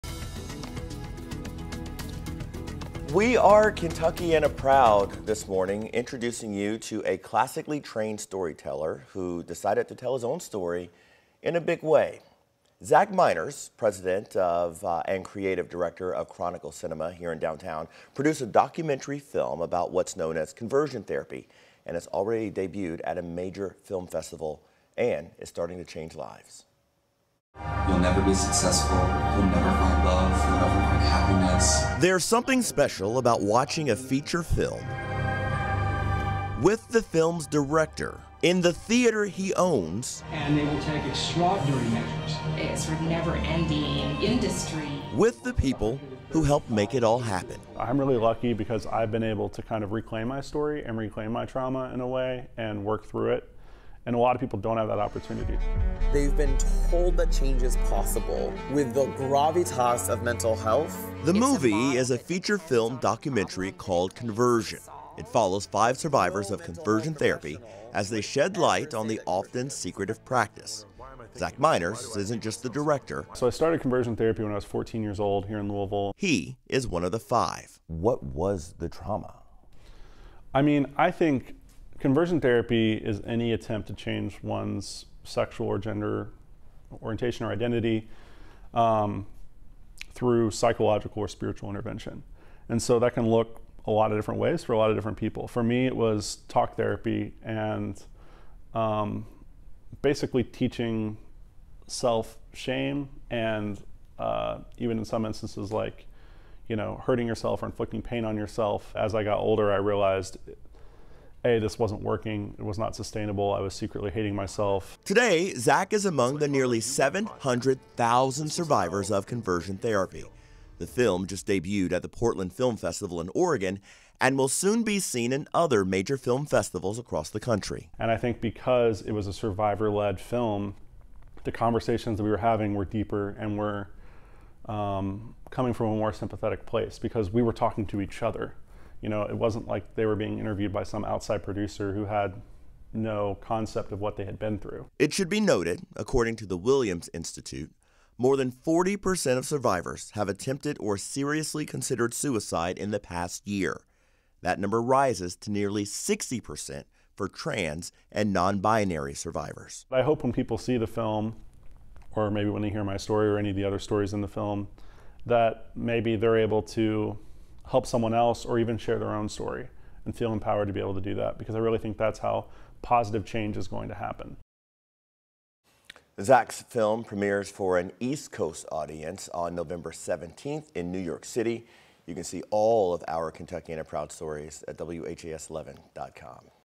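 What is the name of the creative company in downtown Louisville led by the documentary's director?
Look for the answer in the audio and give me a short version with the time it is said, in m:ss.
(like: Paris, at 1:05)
Chronicle Cinema, at 0:16.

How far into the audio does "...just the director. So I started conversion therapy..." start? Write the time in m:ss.
1:12.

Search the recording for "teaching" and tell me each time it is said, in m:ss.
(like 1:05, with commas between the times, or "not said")
1:40.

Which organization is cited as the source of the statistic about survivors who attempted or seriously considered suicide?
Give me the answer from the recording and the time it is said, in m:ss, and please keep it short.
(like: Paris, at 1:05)
Williams Institute, at 2:26.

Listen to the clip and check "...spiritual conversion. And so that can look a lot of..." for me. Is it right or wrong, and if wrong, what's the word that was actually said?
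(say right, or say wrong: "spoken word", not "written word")
wrong: "intervention", not "conversion".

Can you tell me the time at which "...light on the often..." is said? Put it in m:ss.
1:08.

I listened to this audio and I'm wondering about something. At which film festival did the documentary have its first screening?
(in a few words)
Portland Film Festival.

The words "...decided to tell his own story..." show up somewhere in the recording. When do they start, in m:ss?
0:09.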